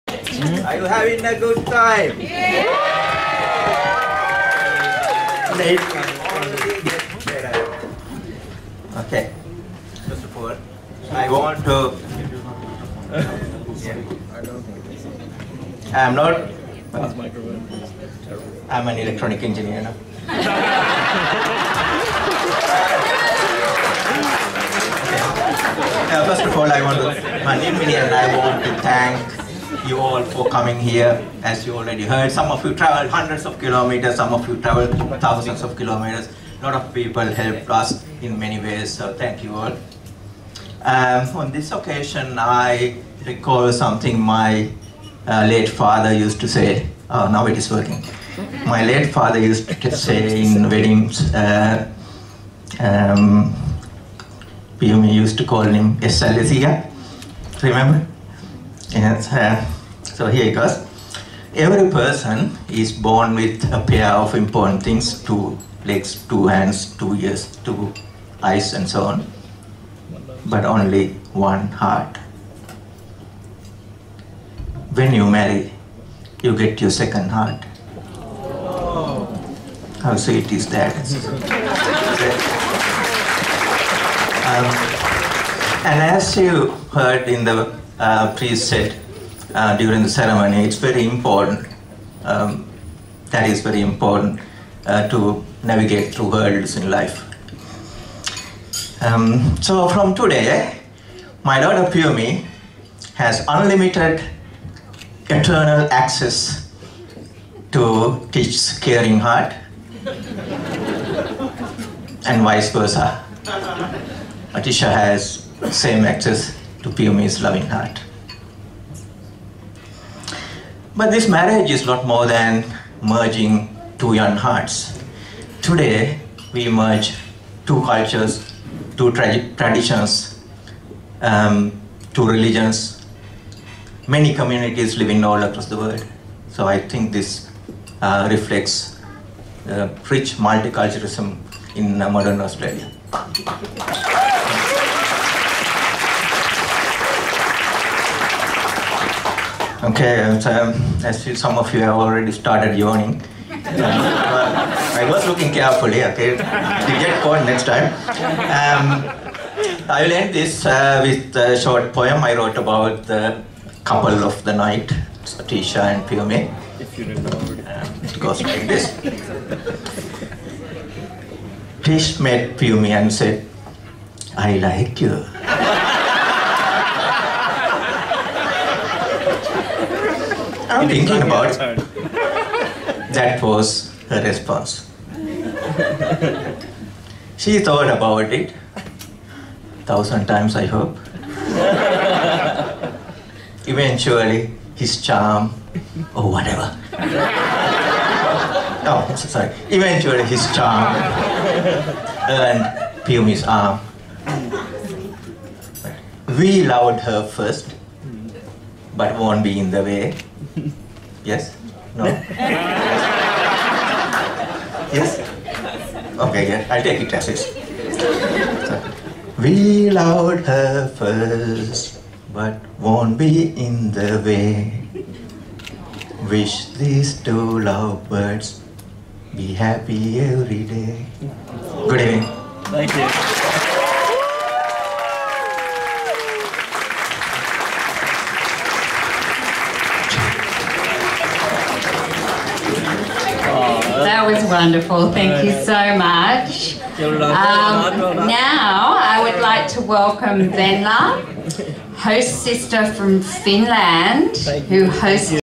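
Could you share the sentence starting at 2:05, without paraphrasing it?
Today, we merge two cultures, two tra traditions, um, two religions.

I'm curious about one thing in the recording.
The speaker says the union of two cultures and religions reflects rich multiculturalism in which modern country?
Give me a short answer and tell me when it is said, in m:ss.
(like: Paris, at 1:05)
Australia, at 2:22.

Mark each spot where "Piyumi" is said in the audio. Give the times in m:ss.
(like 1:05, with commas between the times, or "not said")
1:56, 2:46, 2:52, 3:23.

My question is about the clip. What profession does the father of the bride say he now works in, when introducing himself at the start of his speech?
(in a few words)
Electronic engineer.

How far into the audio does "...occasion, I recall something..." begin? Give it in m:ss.
0:41.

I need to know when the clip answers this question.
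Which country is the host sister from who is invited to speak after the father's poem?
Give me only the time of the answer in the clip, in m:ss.
4:13.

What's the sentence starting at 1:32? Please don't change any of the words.
Um, that is very important uh, to navigate through hurdles in life.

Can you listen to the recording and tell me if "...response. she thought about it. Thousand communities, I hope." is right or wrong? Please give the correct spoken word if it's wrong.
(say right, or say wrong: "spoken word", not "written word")
wrong: "times", not "communities".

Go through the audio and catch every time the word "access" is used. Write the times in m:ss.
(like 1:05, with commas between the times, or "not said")
1:45, 1:56.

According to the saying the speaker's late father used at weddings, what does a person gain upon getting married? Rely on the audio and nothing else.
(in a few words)
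Second heart.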